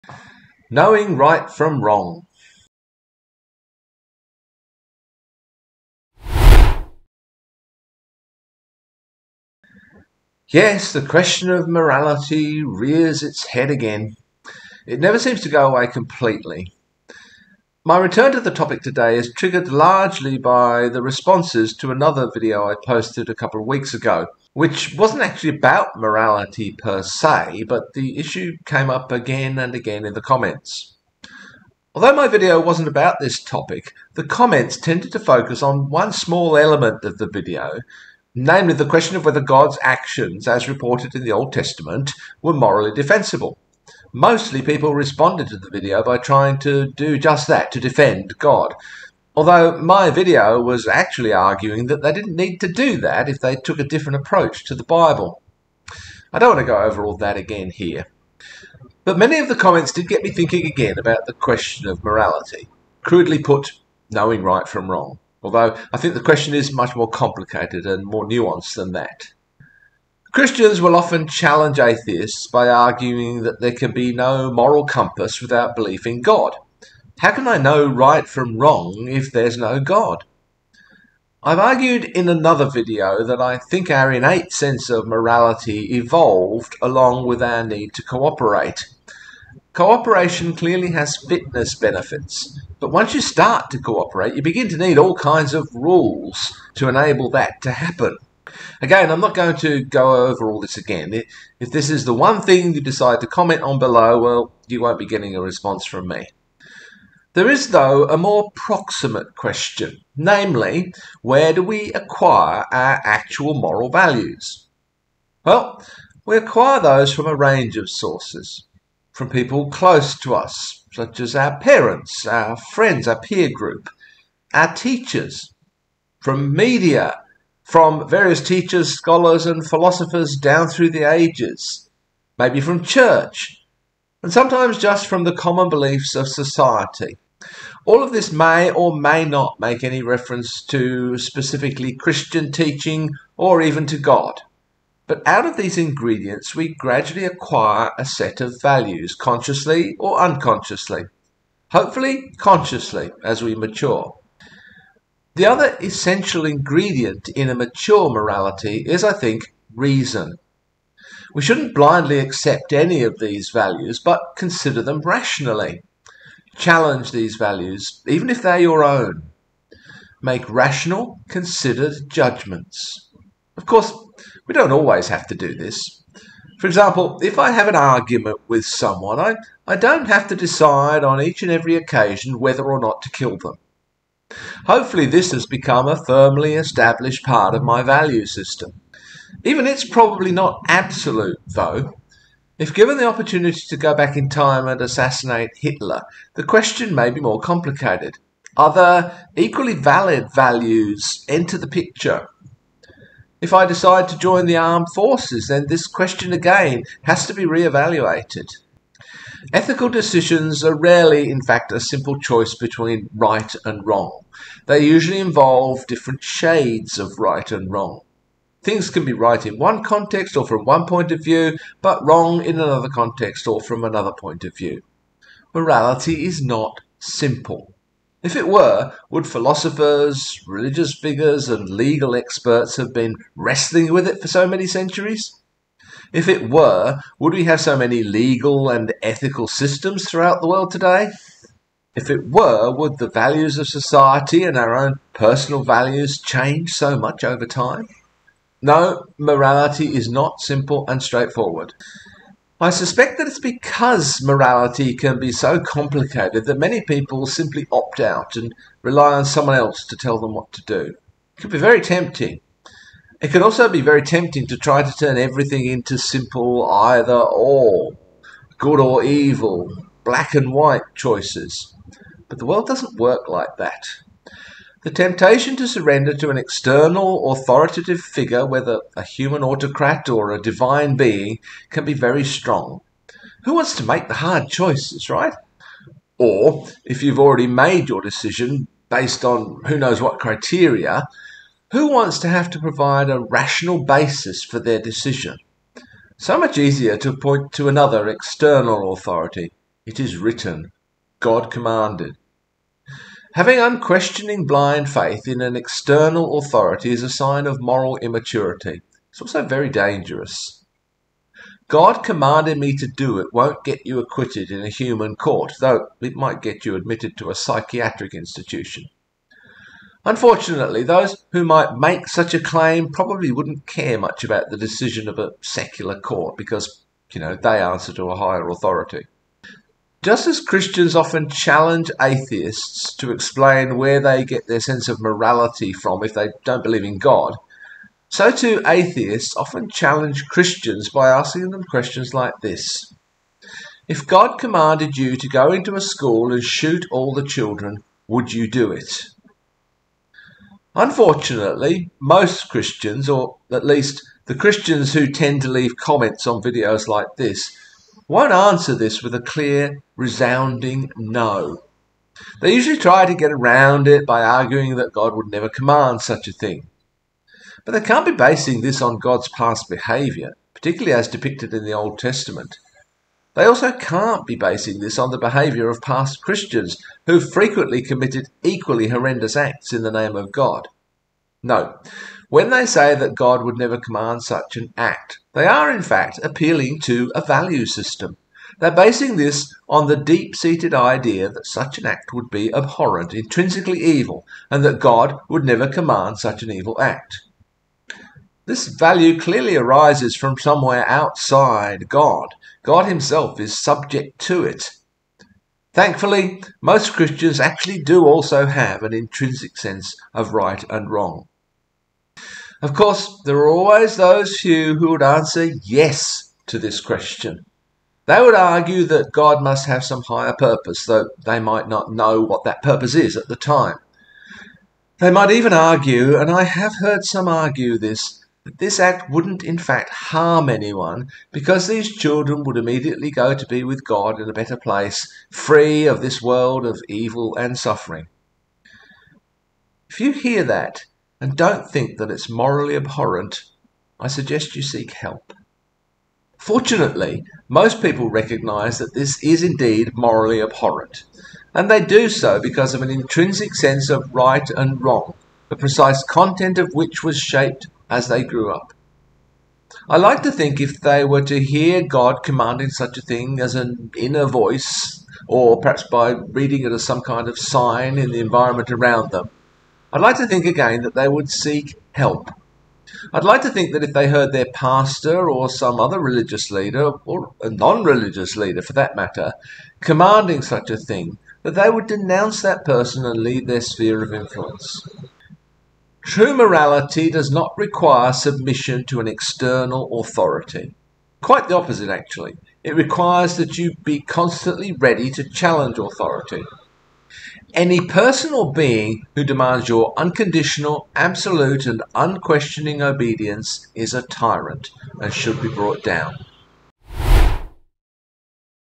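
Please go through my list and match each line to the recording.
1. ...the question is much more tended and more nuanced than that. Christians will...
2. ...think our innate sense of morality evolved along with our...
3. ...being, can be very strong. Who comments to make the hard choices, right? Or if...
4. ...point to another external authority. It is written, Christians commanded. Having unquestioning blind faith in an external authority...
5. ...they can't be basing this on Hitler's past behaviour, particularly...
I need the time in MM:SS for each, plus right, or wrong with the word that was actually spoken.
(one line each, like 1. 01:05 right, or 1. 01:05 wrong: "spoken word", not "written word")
1. 01:06 wrong: "complicated", not "tended"
2. 01:23 right
3. 04:40 wrong: "wants", not "comments"
4. 04:57 wrong: "God", not "Christians"
5. 06:07 wrong: "God", not "Hitler".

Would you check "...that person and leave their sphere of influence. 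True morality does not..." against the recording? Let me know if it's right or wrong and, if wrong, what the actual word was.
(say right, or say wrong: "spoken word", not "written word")
right.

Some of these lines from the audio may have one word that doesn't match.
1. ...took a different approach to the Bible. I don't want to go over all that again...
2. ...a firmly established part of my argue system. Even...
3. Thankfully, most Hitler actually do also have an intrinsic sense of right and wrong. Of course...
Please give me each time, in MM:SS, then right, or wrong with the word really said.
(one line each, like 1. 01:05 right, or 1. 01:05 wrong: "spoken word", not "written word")
1. 00:53 right
2. 03:05 wrong: "value", not "argue"
3. 06:45 wrong: "Christians", not "Hitler".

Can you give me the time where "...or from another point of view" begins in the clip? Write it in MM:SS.
03:43.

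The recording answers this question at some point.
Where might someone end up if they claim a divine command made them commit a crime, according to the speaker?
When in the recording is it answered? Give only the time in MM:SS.
05:17.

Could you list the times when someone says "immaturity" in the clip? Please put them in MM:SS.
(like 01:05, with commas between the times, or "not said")
05:07.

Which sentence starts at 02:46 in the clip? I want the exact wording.
Challenge these values, even if they're your own.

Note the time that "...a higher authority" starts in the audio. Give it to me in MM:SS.
05:28.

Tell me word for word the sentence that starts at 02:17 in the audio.
All of this may or may not make any reference to specifically Christian teaching or even to God.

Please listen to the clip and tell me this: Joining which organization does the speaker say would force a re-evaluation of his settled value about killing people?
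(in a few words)
The armed forces.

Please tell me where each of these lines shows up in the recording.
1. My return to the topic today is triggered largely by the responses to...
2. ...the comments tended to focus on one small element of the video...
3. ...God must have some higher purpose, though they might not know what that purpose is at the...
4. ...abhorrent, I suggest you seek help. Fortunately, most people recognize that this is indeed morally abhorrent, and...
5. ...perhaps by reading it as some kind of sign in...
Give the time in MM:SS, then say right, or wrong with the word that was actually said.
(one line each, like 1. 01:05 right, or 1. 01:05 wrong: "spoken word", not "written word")
1. 00:17 right
2. 00:34 right
3. 06:59 right
4. 07:22 right
5. 07:45 right.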